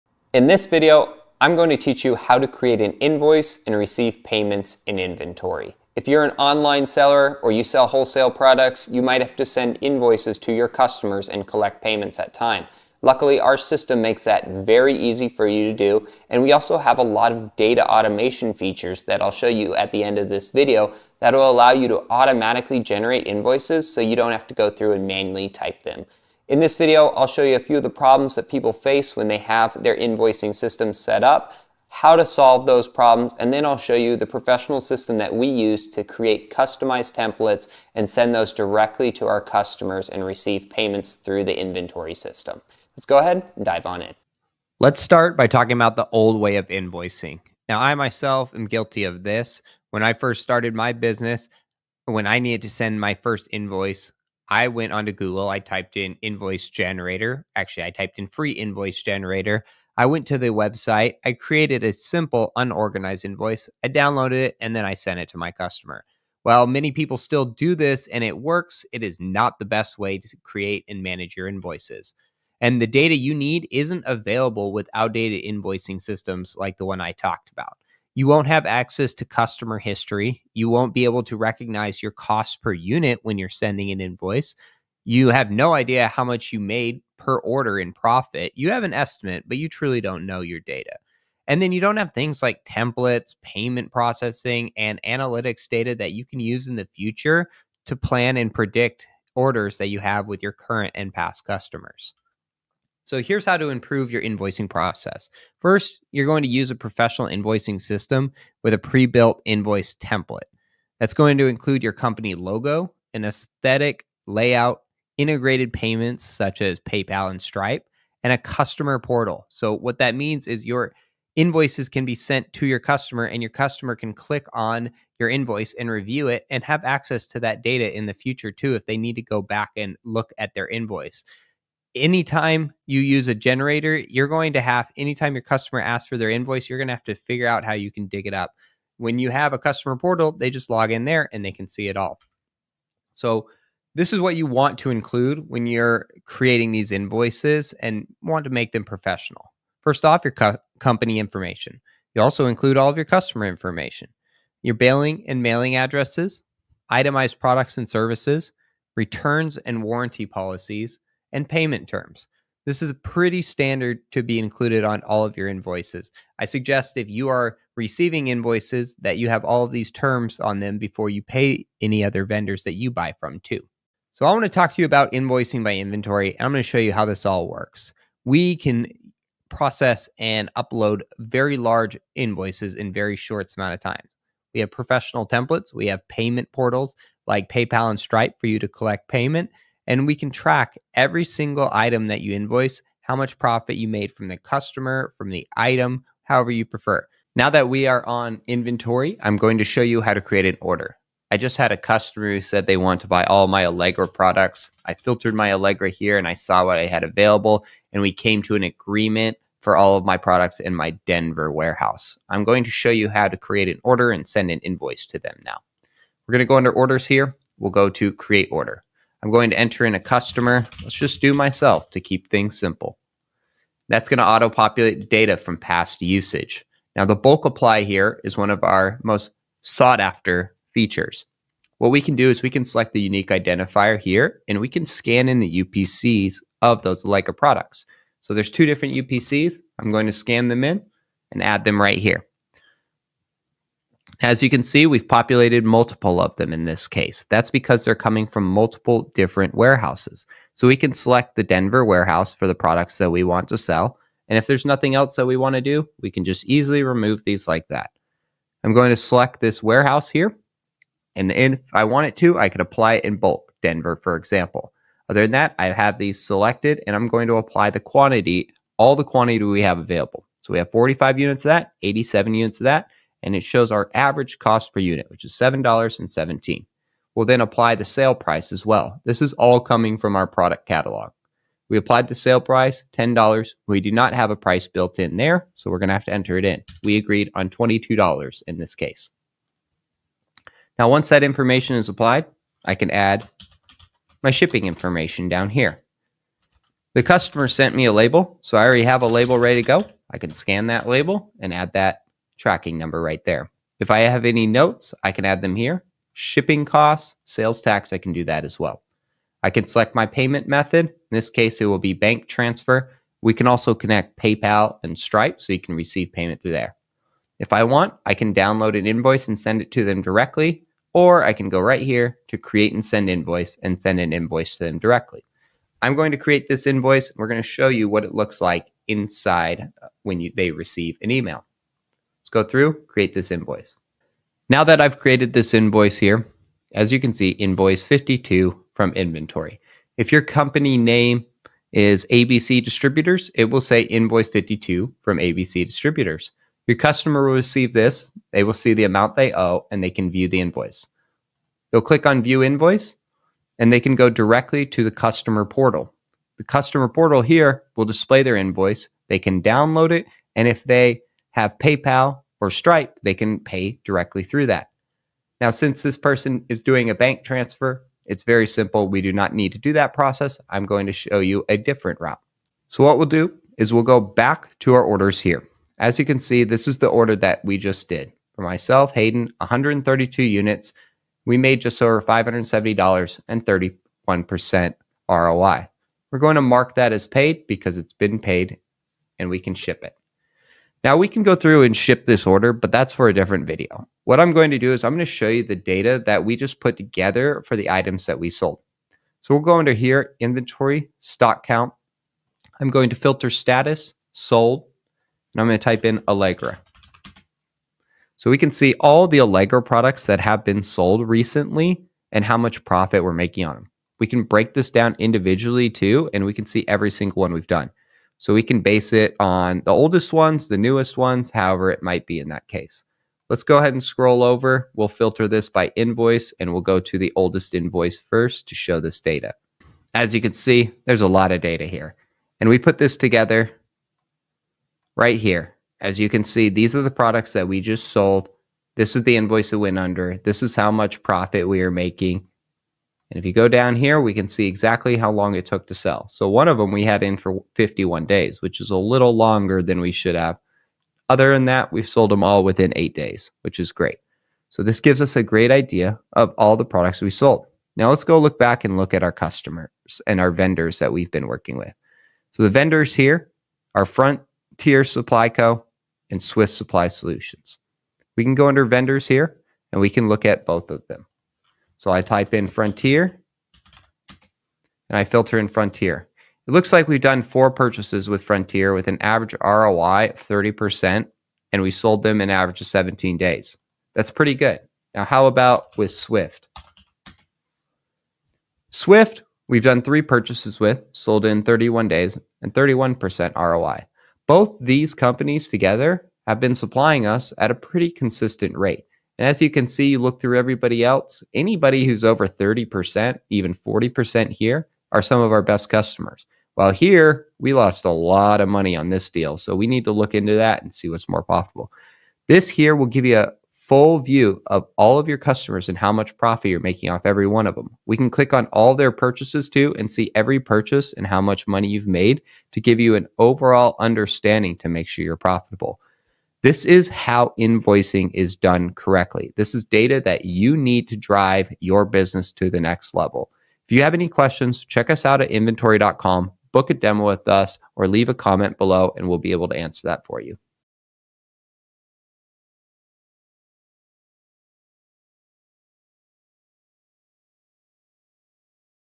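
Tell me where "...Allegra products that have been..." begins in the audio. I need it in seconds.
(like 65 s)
409 s.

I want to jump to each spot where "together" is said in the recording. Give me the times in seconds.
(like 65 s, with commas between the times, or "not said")
396 s, 432 s, 495 s.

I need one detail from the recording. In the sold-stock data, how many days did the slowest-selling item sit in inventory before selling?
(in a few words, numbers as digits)
51.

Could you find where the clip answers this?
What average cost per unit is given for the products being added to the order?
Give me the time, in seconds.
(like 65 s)
275 s.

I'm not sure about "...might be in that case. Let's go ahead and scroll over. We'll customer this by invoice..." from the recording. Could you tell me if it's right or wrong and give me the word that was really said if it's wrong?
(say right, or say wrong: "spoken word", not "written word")
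wrong: "filter", not "customer".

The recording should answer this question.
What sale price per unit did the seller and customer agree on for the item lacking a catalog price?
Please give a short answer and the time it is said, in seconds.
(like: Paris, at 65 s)
$22, at 287 s.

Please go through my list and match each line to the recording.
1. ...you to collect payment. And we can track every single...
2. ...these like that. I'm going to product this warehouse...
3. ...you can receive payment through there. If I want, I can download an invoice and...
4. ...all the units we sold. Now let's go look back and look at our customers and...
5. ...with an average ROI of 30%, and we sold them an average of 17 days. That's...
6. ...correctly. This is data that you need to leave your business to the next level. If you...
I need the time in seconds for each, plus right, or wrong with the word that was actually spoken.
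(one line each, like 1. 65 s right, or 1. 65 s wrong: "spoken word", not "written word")
1. 188 s right
2. 257 s wrong: "select", not "product"
3. 315 s right
4. 456 s wrong: "products", not "units"
5. 478 s right
6. 528 s wrong: "drive", not "leave".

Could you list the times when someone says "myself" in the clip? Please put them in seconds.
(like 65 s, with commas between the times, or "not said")
47 s, 221 s, 378 s.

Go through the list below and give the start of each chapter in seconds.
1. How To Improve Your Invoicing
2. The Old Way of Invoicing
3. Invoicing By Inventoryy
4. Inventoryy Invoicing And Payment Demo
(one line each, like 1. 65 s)
1. 102 s
2. 44 s
3. 173 s
4. 197 s.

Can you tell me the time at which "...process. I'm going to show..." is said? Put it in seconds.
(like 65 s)
369 s.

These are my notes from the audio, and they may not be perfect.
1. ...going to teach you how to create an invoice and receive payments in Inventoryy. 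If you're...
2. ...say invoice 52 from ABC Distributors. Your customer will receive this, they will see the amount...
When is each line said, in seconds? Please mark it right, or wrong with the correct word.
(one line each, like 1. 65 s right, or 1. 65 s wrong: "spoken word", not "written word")
1. 1 s right
2. 343 s right.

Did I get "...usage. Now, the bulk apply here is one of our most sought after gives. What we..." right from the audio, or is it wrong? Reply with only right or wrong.
wrong.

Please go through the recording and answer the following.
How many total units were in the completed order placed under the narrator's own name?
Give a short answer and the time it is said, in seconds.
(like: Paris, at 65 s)
132, at 379 s.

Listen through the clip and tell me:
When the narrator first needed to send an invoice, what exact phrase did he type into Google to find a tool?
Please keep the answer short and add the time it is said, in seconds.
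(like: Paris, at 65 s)
free invoice generator, at 58 s.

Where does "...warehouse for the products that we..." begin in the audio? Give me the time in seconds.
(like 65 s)
251 s.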